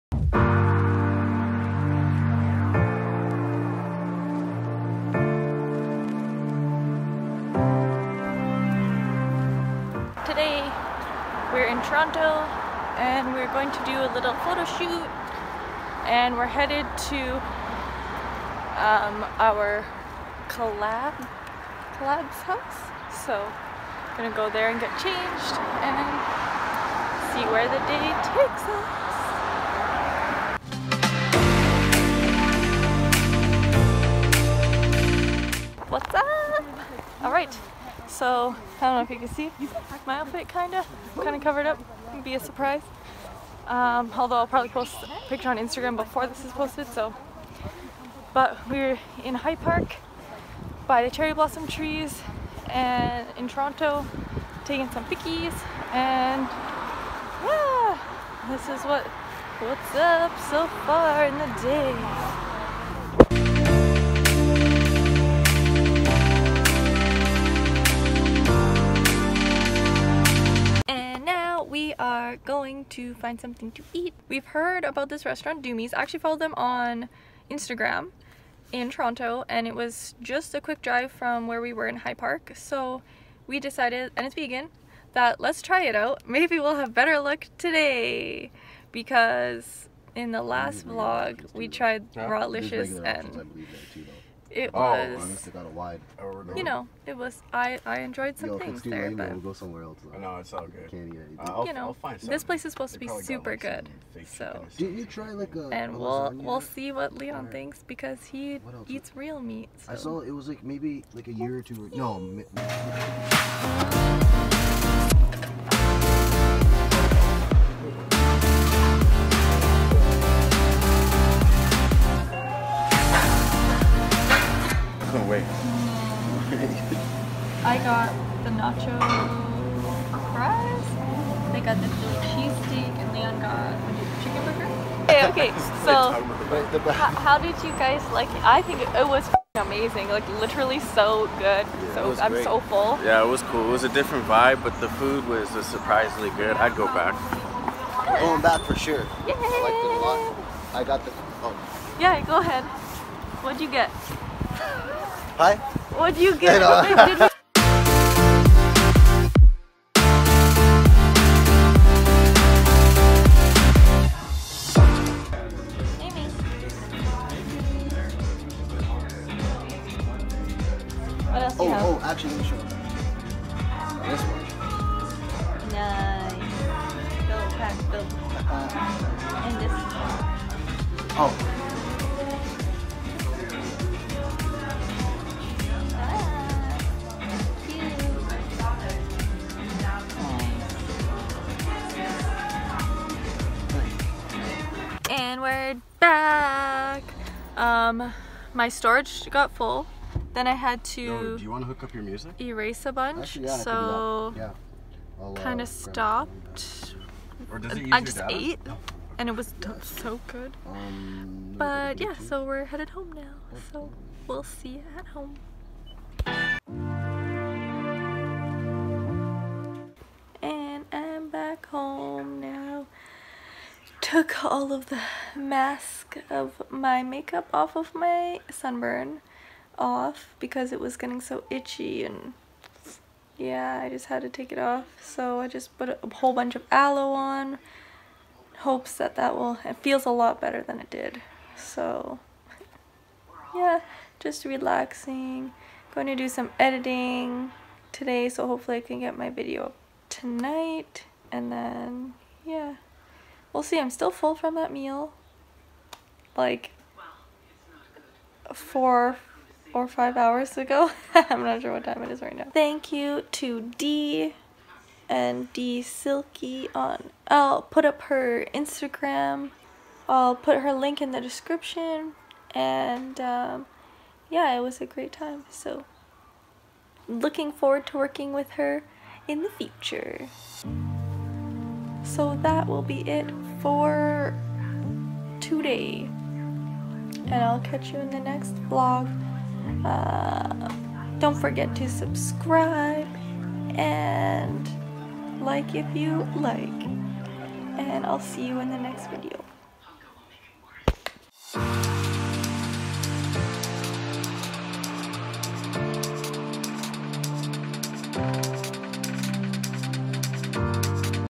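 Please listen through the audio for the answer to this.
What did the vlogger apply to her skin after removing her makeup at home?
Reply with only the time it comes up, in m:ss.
3:56.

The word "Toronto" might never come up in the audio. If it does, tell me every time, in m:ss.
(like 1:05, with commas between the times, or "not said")
0:11, 0:53, 1:18.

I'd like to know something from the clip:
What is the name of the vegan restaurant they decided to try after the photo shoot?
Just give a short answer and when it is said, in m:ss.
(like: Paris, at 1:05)
Doomies, at 1:15.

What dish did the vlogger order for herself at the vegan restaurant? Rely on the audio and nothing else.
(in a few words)
nacho fries.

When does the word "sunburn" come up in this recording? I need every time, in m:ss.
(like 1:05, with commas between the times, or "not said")
3:48.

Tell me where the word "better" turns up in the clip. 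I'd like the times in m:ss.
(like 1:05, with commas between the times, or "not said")
1:26, 4:00.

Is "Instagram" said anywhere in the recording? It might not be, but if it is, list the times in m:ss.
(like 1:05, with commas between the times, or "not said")
0:45, 1:17, 4:28.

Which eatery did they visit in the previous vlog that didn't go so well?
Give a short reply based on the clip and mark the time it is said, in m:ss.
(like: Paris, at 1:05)
Rawlicious, at 1:32.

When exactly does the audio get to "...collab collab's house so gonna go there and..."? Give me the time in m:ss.
0:20.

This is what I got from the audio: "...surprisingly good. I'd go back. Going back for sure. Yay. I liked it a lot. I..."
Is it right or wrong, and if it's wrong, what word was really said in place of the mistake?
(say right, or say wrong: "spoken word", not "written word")
right.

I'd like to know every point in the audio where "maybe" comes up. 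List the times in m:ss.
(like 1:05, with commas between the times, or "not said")
1:26, 1:50.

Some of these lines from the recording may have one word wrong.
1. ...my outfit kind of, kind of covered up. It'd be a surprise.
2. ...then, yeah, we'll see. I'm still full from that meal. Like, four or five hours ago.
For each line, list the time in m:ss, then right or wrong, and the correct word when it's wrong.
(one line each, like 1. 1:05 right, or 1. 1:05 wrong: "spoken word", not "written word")
1. 0:40 right
2. 4:11 right.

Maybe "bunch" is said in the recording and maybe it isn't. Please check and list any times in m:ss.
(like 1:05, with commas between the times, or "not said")
3:22, 3:56.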